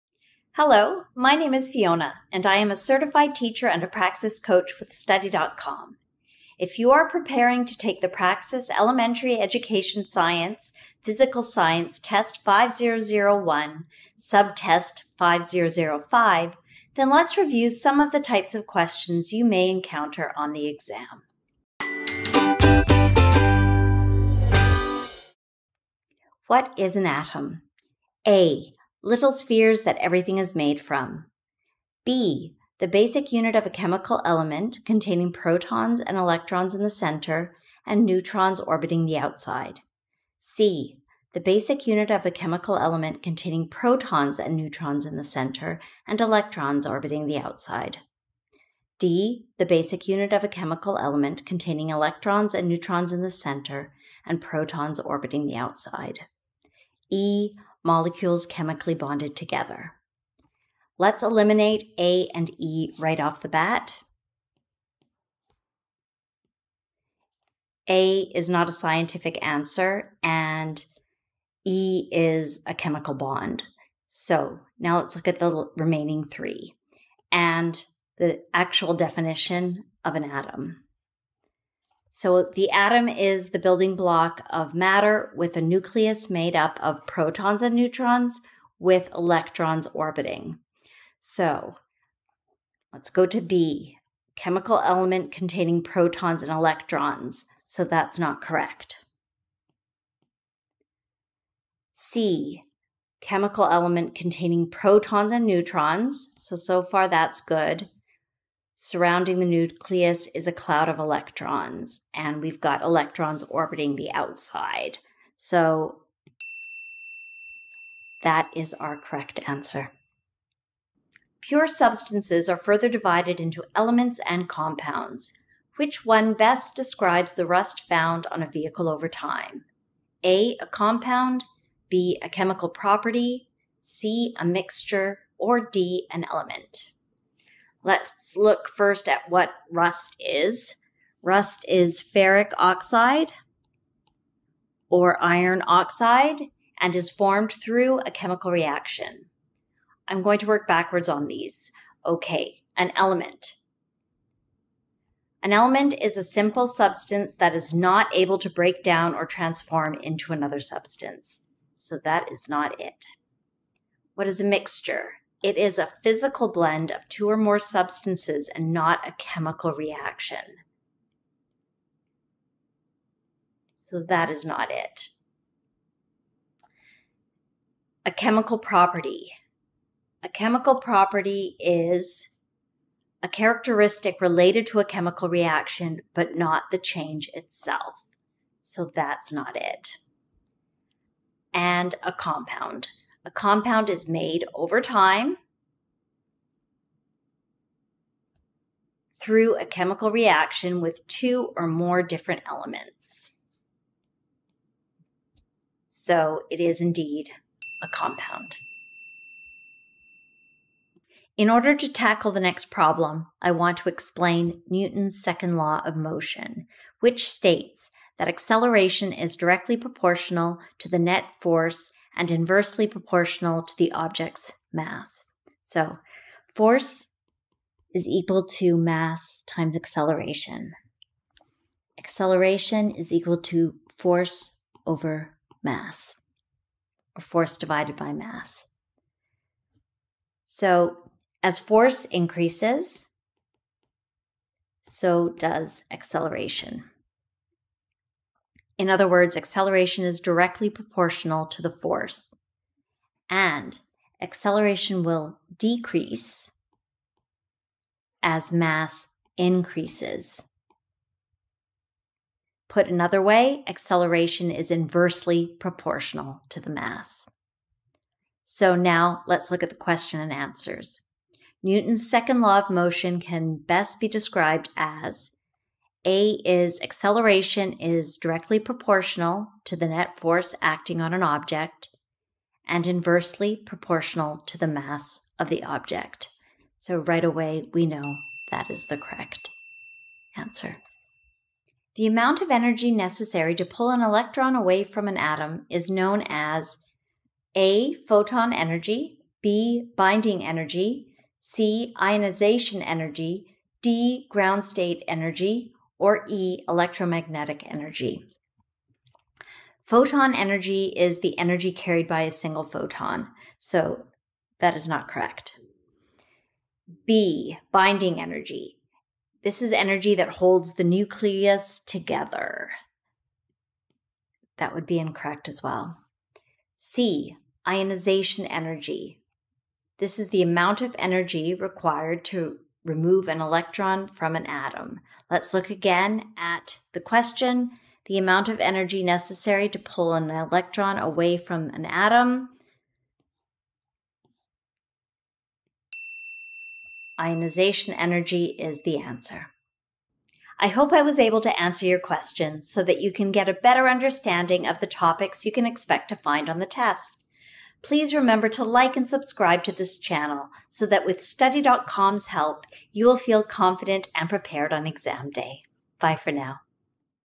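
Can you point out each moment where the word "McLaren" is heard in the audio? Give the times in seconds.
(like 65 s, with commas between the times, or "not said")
not said.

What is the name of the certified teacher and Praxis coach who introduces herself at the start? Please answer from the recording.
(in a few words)
Fiona.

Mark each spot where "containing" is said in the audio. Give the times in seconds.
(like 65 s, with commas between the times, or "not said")
34 s, 43 s, 51 s, 95 s, 104 s.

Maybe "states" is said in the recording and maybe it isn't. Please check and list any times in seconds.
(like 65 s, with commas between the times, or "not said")
217 s, 304 s.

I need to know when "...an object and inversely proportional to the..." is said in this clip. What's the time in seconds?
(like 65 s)
281 s.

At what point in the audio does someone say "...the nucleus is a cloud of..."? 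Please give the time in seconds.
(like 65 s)
109 s.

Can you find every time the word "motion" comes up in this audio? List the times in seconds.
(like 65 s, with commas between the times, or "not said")
215 s, 272 s.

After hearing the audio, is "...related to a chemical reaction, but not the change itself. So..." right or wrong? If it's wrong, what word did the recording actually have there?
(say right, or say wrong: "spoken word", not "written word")
right.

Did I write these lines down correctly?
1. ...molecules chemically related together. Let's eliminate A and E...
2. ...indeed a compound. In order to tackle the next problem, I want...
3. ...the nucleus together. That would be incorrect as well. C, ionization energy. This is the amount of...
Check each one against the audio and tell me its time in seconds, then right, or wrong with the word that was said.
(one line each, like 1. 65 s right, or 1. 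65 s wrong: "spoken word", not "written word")
1. 57 s wrong: "bonded", not "related"
2. 206 s right
3. 320 s right.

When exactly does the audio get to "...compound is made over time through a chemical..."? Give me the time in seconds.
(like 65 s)
193 s.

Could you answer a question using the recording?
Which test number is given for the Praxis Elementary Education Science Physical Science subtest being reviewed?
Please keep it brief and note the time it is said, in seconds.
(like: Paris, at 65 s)
5005, at 15 s.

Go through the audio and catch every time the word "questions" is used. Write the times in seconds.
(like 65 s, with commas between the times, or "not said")
18 s, 269 s, 337 s, 351 s.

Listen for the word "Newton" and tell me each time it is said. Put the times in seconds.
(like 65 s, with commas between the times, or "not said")
214 s, 271 s.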